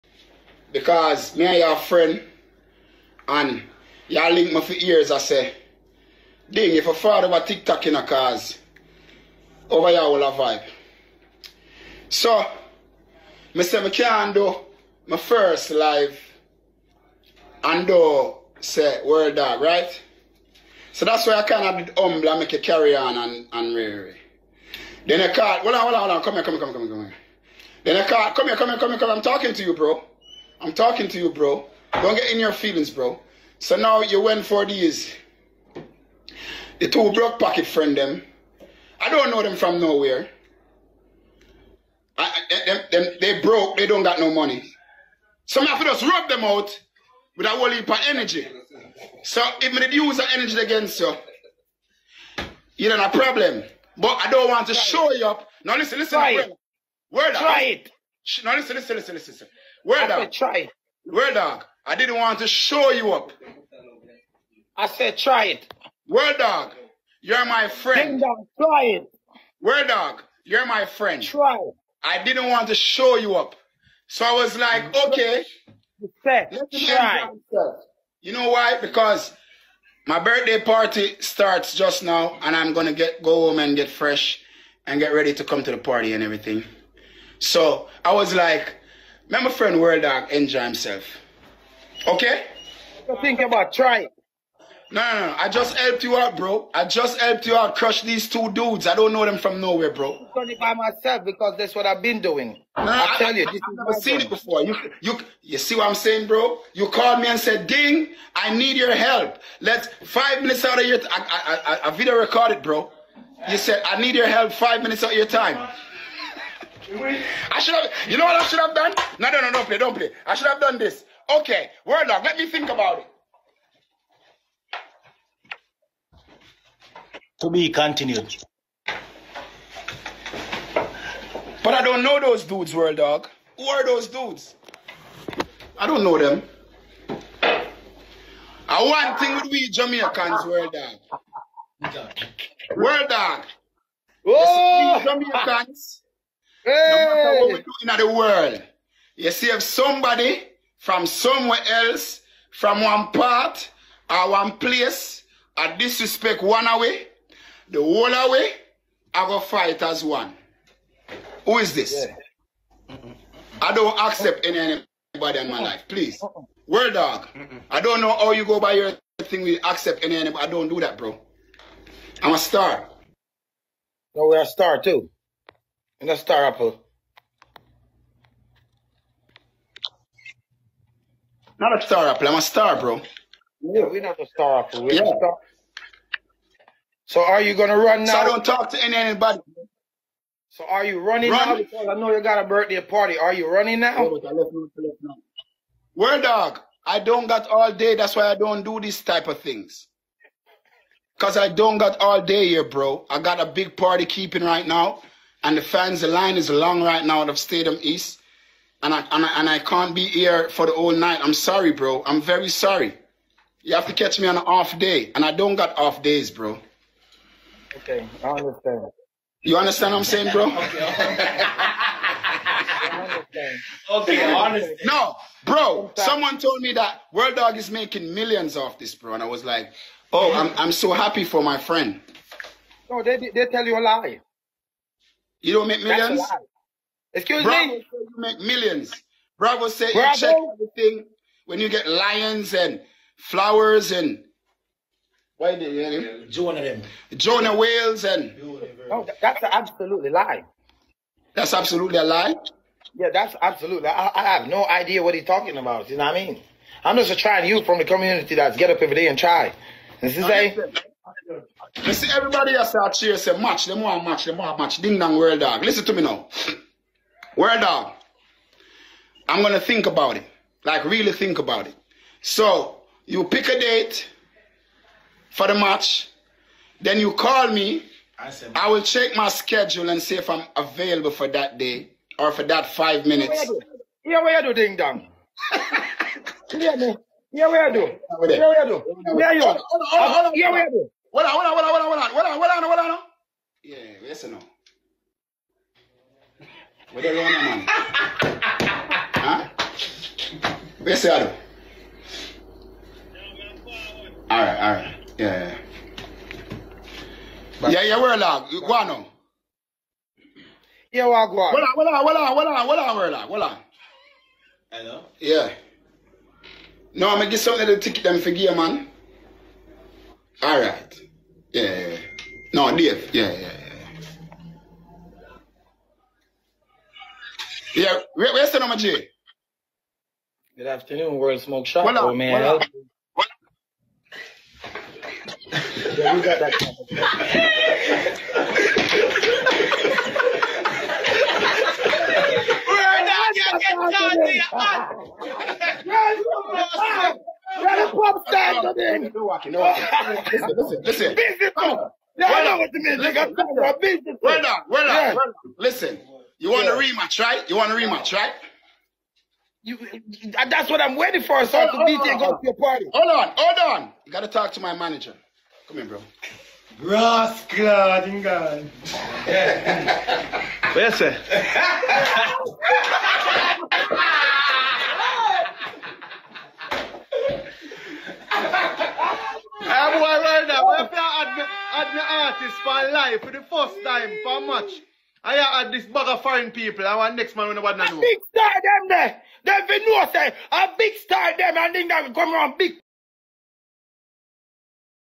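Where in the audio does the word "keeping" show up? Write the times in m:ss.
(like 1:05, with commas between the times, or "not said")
3:24.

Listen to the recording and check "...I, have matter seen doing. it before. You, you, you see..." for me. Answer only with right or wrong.
wrong.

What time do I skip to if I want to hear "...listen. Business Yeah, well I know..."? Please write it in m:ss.
5:50.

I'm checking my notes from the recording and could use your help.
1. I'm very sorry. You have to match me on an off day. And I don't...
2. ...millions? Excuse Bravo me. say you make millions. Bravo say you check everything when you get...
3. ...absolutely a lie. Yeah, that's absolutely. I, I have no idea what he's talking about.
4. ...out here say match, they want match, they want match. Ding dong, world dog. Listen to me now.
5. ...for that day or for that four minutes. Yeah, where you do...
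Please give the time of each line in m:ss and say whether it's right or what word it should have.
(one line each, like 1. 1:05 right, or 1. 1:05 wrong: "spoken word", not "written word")
1. 3:32 wrong: "catch", not "match"
2. 3:55 right
3. 4:11 right
4. 4:22 right
5. 4:41 wrong: "five", not "four".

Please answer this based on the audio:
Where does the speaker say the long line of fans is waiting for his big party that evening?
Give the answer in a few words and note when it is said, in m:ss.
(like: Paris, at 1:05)
Stadium East, at 3:27.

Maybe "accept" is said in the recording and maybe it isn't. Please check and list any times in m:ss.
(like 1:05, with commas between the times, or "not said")
2:43, 2:49.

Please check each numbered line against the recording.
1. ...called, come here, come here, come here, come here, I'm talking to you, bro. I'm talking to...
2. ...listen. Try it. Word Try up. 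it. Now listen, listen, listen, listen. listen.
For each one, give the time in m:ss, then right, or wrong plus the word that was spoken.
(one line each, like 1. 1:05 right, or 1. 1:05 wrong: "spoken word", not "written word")
1. 0:28 right
2. 0:55 right.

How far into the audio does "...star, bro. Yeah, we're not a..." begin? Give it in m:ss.
3:02.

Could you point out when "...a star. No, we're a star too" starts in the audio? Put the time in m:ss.
2:52.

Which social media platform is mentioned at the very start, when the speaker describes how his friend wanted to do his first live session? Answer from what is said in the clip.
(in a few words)
TikTok.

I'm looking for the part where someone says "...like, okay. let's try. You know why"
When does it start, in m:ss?
1:14.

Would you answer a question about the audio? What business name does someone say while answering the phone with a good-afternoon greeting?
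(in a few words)
World Smoke Shop.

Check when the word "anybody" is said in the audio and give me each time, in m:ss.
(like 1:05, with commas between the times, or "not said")
2:45, 2:50, 3:08.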